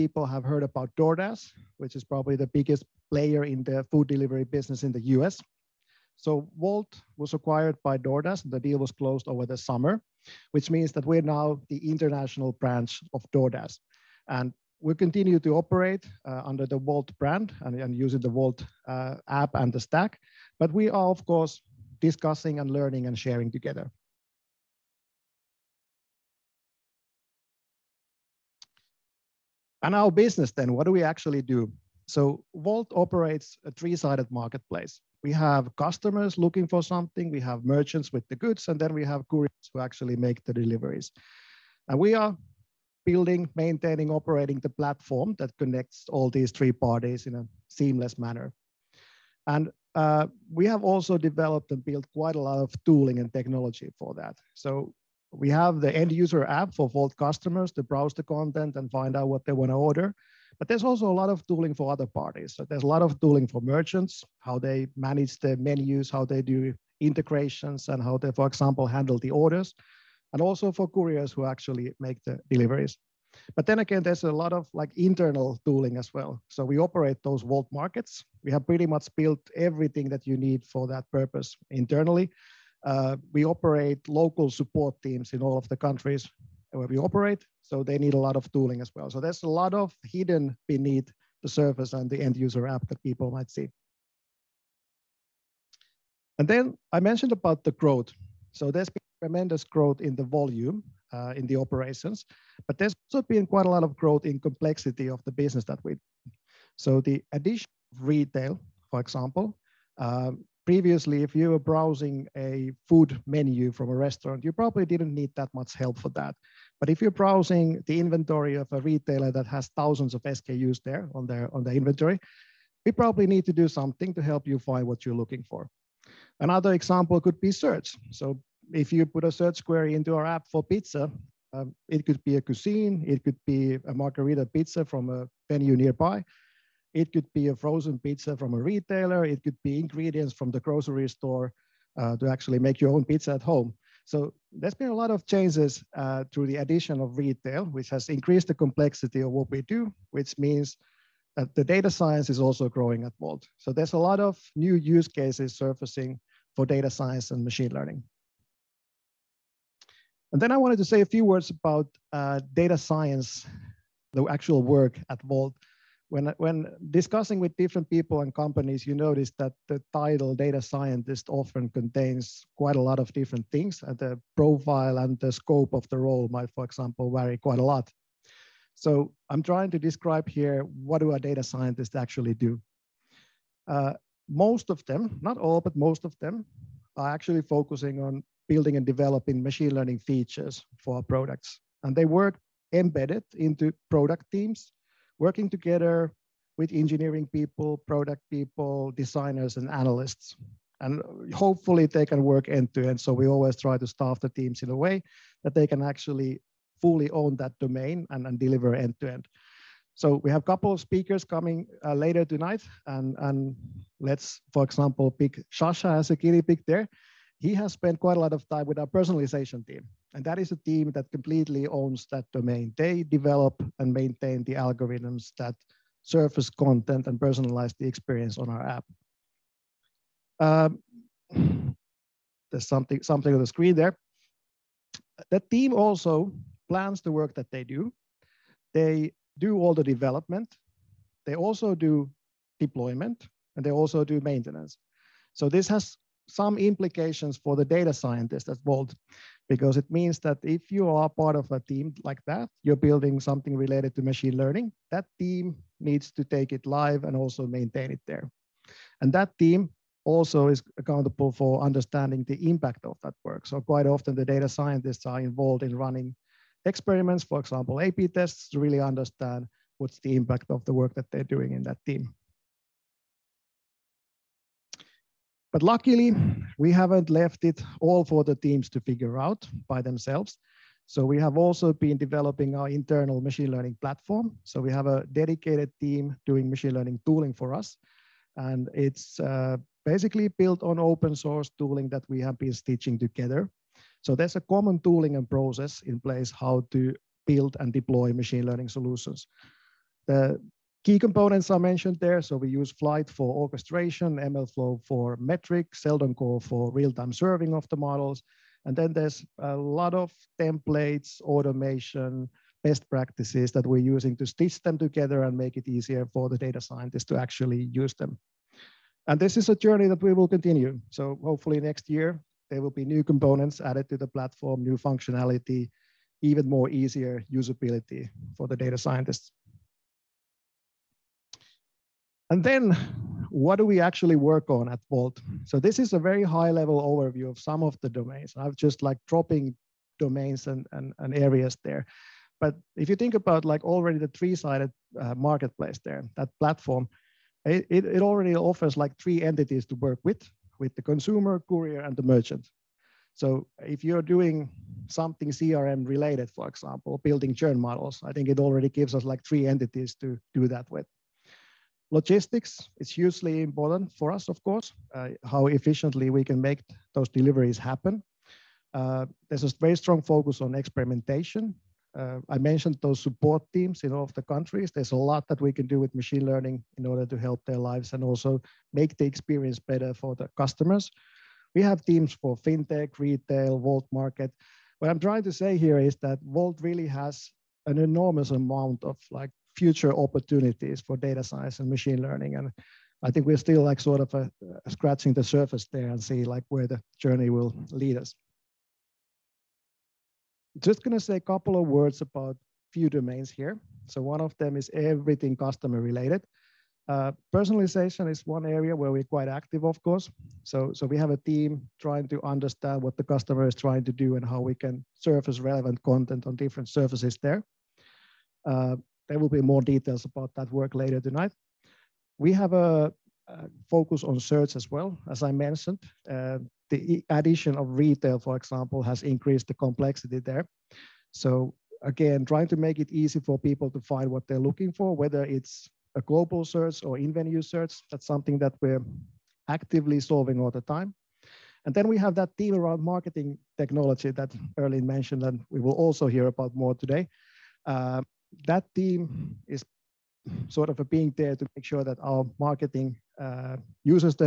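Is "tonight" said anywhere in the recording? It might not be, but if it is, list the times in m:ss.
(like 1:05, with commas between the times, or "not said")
3:32, 7:00.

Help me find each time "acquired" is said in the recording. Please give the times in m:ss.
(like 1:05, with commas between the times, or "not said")
0:07.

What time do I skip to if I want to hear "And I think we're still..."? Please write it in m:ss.
6:32.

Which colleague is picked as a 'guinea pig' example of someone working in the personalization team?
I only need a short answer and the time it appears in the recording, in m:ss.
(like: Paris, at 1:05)
Shasha, at 3:35.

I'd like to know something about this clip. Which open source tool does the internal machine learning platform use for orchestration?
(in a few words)
Flyte.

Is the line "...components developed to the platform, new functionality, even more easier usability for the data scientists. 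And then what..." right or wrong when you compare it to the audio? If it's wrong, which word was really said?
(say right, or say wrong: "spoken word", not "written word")
wrong: "added", not "developed".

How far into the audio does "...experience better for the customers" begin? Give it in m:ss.
6:19.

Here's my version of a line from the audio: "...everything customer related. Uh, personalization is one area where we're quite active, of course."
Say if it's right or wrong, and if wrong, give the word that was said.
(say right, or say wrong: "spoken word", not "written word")
right.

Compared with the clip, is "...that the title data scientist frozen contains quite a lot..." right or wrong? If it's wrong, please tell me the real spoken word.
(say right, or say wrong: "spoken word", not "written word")
wrong: "often", not "frozen".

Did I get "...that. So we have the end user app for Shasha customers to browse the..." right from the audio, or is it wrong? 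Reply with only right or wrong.
wrong.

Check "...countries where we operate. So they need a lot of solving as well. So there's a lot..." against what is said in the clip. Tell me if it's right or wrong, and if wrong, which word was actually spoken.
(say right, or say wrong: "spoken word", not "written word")
wrong: "tooling", not "solving".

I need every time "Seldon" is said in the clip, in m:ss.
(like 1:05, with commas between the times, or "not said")
5:05.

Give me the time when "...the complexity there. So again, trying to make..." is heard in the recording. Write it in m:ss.
7:09.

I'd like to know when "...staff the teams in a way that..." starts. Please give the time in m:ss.
3:23.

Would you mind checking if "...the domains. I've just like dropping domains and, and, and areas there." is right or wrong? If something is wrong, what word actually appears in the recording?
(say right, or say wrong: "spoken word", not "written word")
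right.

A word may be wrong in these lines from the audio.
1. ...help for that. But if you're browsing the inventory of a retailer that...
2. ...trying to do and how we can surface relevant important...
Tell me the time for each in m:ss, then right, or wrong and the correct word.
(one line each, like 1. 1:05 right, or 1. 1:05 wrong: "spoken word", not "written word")
1. 1:55 right
2. 6:53 wrong: "content", not "important".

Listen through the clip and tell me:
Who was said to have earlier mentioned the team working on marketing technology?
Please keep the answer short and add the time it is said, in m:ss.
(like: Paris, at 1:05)
Erlin, at 7:24.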